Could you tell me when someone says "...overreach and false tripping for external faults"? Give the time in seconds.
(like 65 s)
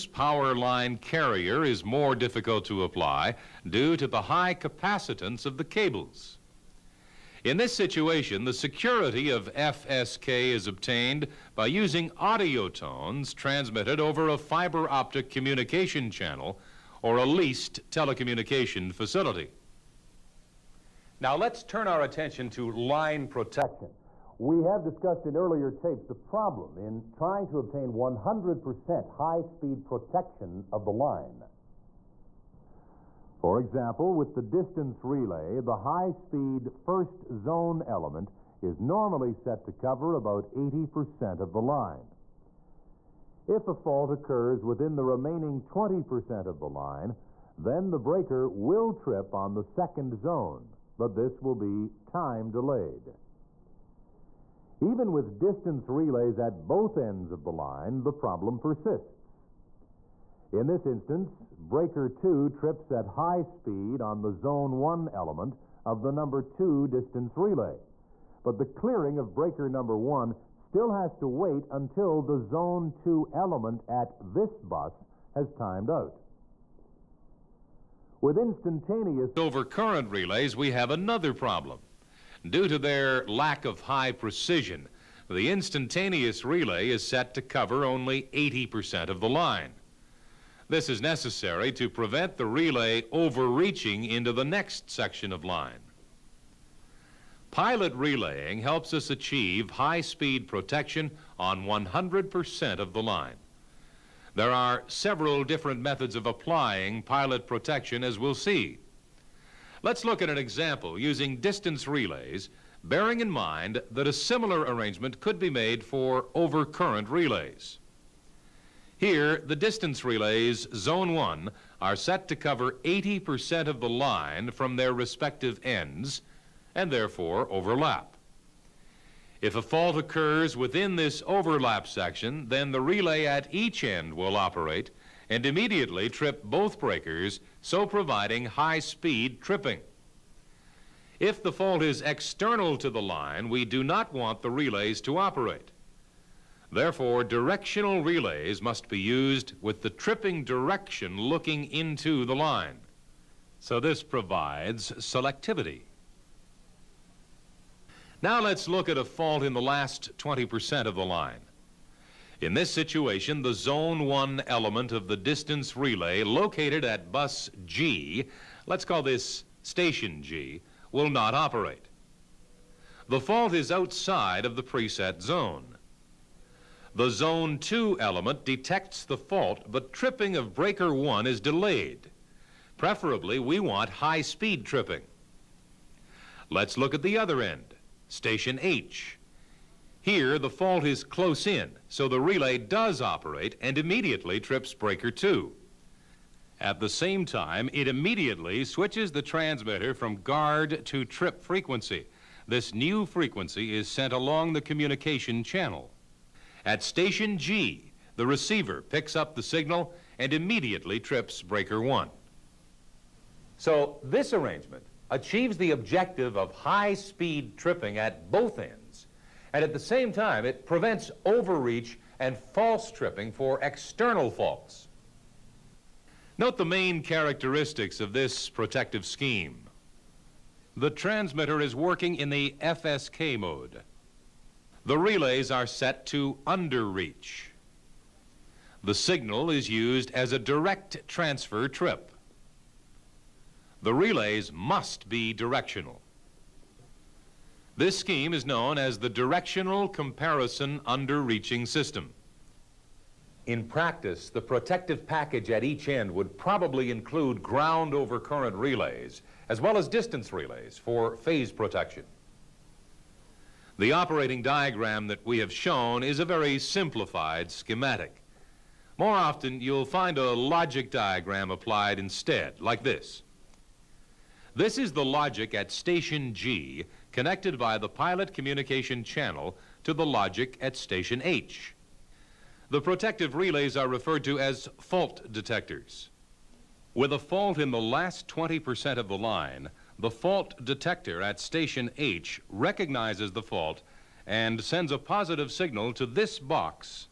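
221 s.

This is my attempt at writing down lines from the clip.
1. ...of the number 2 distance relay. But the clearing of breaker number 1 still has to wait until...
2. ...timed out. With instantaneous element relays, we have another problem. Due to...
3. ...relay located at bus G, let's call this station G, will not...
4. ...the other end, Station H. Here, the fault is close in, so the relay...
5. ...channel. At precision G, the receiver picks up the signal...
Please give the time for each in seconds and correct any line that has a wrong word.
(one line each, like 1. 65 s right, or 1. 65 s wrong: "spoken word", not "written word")
1. 65 s right
2. 75 s wrong: "overcurrent", not "element"
3. 165 s right
4. 187 s right
5. 205 s wrong: "station", not "precision".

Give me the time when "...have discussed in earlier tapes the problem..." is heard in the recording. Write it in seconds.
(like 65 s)
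24 s.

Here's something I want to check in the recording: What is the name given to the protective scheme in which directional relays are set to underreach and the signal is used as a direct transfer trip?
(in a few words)
Directional Comparison Underreaching System.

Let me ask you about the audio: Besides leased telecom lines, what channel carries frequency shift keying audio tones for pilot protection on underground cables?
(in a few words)
fiber optic.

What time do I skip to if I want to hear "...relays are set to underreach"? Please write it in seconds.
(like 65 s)
234 s.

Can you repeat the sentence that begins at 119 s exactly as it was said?
Here, the distance relays, Zone 1, are set to cover 80% of the line from their respective ends and therefore overlap.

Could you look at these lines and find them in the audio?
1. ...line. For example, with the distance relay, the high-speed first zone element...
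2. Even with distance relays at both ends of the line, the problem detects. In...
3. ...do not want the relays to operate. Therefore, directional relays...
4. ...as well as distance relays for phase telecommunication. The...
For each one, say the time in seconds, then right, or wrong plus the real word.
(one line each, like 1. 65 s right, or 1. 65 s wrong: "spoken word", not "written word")
1. 30 s right
2. 54 s wrong: "persists", not "detects"
3. 143 s right
4. 259 s wrong: "protection", not "telecommunication".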